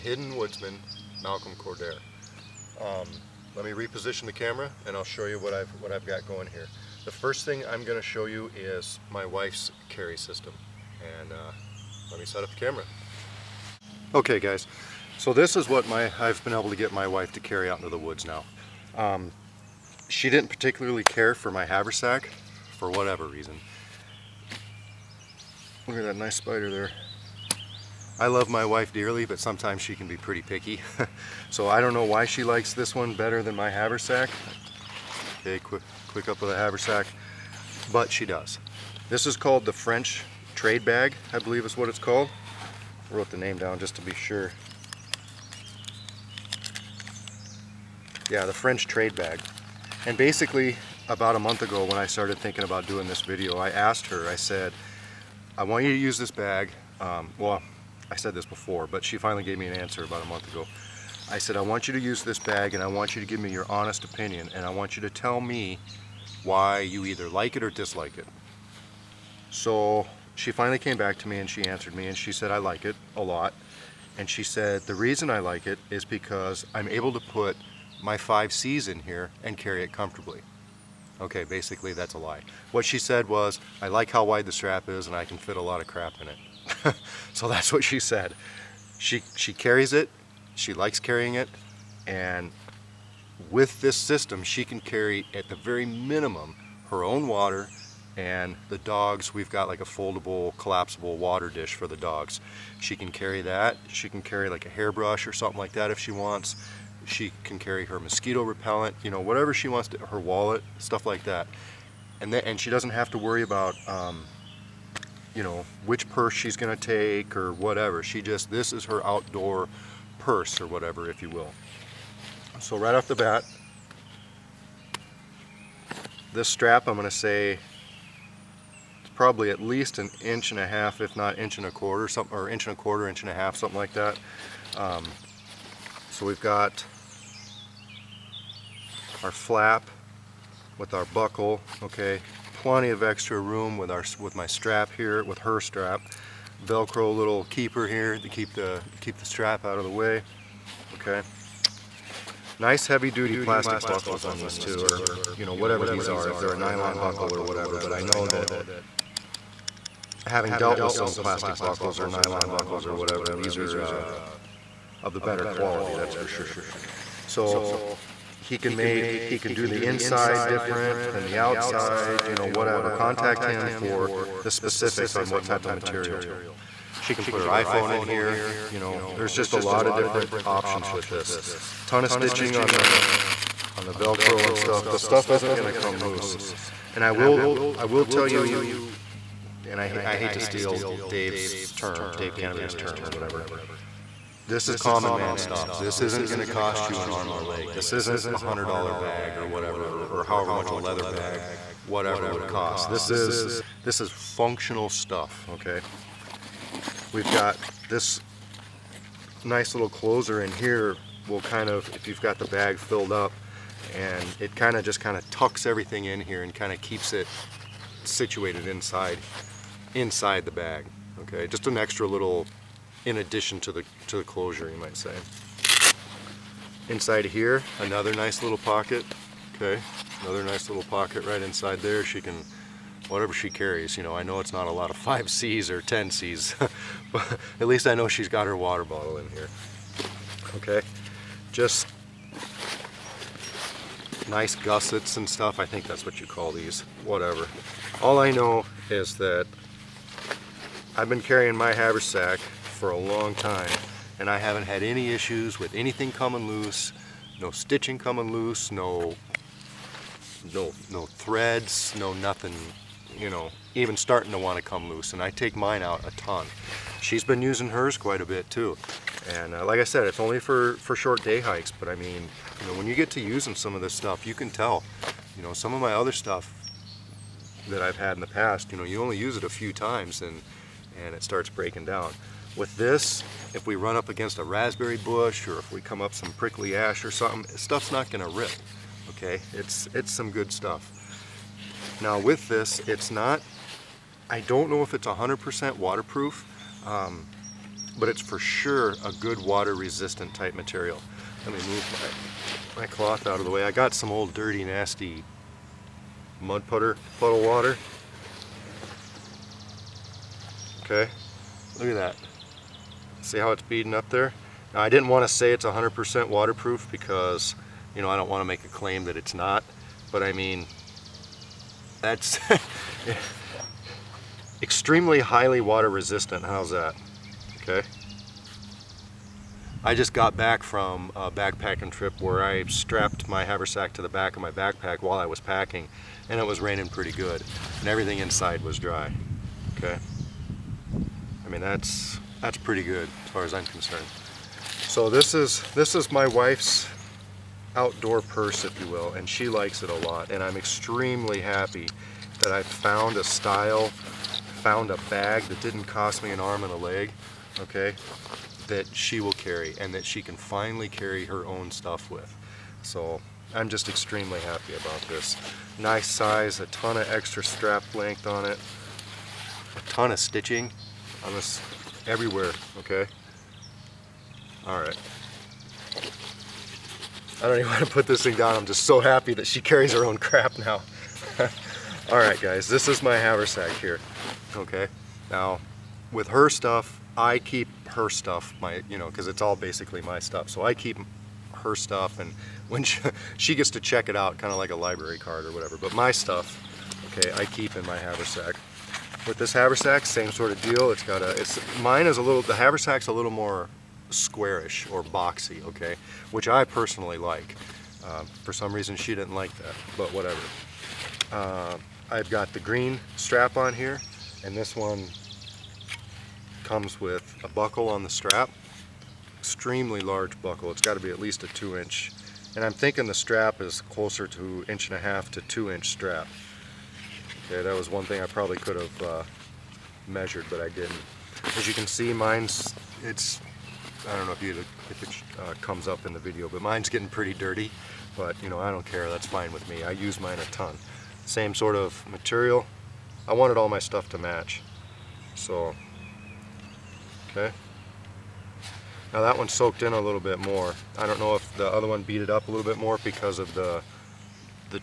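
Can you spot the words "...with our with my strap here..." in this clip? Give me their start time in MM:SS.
02:23.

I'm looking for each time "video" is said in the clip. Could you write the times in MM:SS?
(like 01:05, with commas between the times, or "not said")
00:53, 07:16.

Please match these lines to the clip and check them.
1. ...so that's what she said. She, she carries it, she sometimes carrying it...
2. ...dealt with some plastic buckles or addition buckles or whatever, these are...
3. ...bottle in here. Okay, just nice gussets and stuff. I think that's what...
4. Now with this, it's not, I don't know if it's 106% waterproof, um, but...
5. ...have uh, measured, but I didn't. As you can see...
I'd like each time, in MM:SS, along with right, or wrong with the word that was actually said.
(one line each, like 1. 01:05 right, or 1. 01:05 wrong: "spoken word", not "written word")
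1. 01:27 wrong: "likes", not "sometimes"
2. 02:40 wrong: "nylon", not "addition"
3. 03:58 right
4. 04:51 wrong: "100", not "106"
5. 07:08 right.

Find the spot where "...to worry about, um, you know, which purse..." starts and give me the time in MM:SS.
01:53.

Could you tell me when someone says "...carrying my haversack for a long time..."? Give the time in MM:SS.
04:11.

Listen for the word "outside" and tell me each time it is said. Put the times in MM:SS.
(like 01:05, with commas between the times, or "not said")
02:51.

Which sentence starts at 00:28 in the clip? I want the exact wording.
I love my wife dearly, but sometimes she can be pretty picky.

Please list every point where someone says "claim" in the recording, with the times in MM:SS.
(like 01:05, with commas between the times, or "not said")
05:18.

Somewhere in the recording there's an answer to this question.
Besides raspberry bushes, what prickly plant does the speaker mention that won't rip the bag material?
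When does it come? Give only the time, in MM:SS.
04:46.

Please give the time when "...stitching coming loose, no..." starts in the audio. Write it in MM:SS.
04:17.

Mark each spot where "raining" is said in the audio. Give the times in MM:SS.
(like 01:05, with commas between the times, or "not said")
05:36.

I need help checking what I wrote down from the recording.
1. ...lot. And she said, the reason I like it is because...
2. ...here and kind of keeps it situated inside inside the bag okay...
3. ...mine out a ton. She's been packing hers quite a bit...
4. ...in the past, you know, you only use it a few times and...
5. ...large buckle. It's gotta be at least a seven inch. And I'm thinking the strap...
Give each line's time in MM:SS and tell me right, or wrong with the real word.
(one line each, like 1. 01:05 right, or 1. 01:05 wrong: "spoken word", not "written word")
1. 01:13 right
2. 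03:36 right
3. 04:25 wrong: "using", not "packing"
4. 04:38 right
5. 07:00 wrong: "two", not "seven".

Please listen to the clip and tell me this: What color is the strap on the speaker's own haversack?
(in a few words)
green.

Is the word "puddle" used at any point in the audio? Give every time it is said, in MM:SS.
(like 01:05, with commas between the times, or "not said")
05:07.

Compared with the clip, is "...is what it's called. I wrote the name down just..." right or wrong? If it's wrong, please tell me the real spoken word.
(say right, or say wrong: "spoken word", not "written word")
right.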